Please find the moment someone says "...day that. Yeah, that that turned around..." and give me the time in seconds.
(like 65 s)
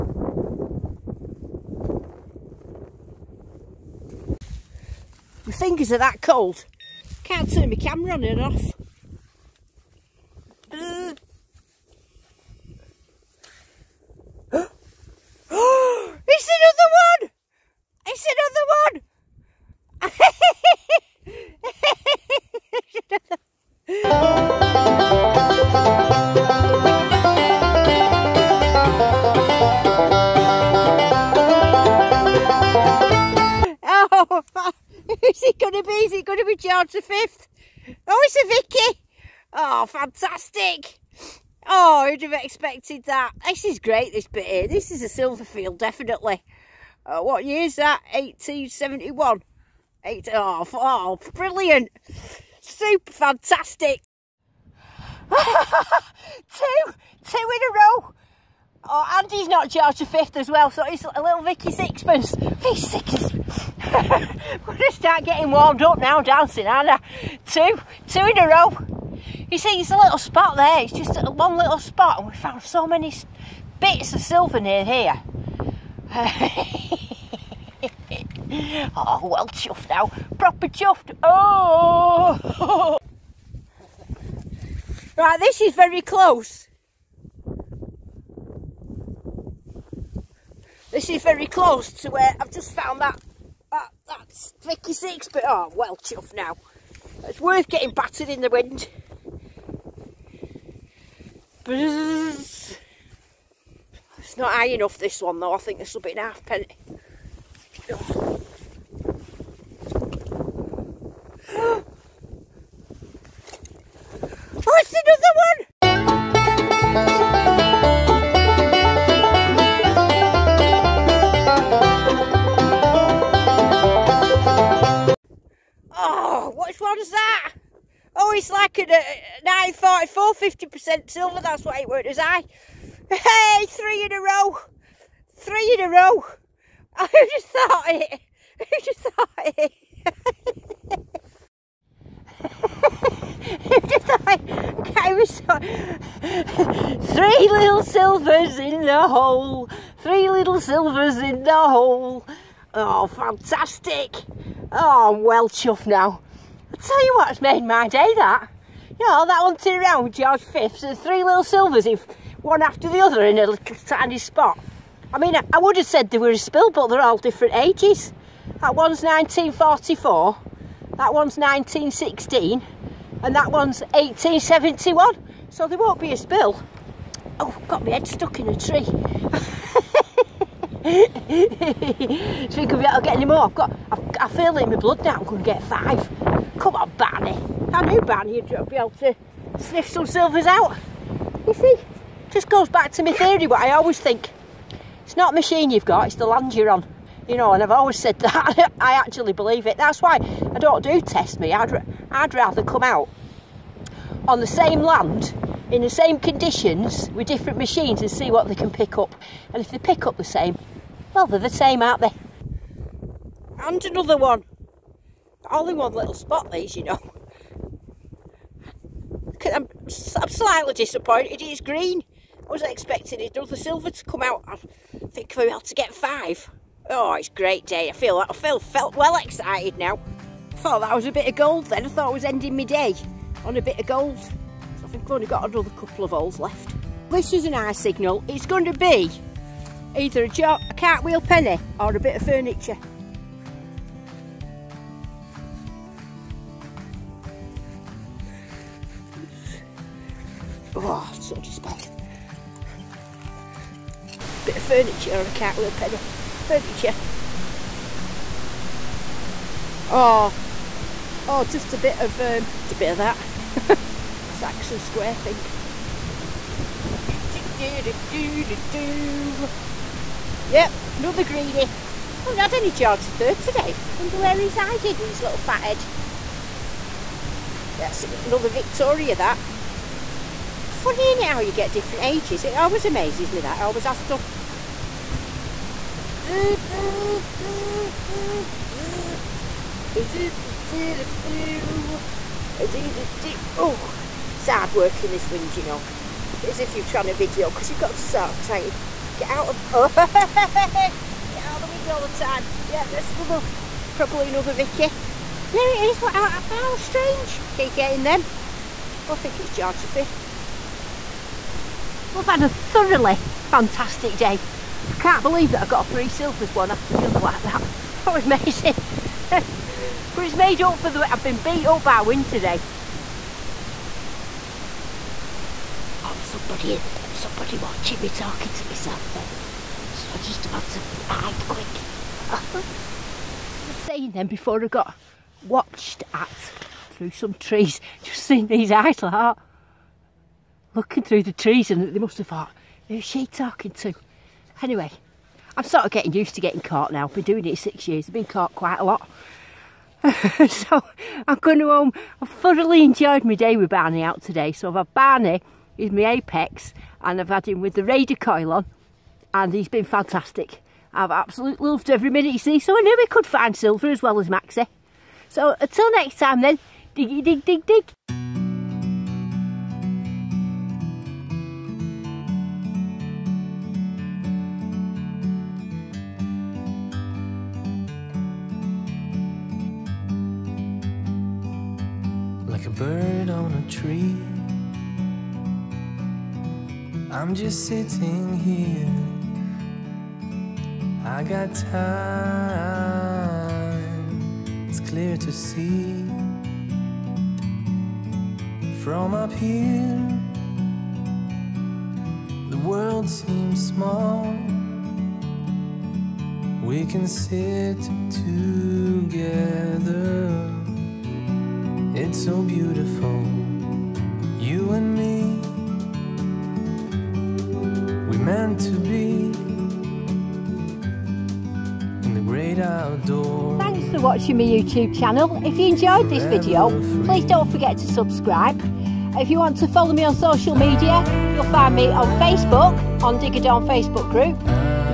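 157 s.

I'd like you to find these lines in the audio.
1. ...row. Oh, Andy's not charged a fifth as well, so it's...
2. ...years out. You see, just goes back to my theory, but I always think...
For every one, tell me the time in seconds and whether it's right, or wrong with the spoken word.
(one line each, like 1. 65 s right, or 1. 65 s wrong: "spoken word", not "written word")
1. 57 s right
2. 190 s wrong: "silvers", not "years".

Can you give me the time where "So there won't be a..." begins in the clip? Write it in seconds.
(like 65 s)
175 s.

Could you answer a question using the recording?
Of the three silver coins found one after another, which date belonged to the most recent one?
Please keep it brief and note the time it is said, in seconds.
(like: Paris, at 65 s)
1944, at 169 s.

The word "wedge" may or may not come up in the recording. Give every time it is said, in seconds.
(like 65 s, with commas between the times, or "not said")
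not said.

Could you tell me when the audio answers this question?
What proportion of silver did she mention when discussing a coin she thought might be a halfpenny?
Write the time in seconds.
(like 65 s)
130 s.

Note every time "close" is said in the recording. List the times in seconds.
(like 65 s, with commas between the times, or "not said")
86 s, 91 s.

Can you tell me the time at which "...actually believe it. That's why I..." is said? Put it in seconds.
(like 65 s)
198 s.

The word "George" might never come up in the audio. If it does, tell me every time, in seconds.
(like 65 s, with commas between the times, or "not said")
160 s, 309 s.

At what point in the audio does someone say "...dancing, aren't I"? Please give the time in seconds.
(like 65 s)
66 s.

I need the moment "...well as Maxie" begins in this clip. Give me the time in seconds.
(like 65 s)
364 s.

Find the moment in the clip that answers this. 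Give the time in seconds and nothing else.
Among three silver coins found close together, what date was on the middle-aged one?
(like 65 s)
171 s.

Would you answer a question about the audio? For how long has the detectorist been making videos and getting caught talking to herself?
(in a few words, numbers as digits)
6 years.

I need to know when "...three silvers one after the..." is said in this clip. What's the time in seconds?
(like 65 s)
315 s.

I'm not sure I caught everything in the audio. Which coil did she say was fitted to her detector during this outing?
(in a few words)
Raider coil.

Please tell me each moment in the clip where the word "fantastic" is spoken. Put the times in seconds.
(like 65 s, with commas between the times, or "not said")
39 s, 53 s, 153 s, 313 s, 359 s.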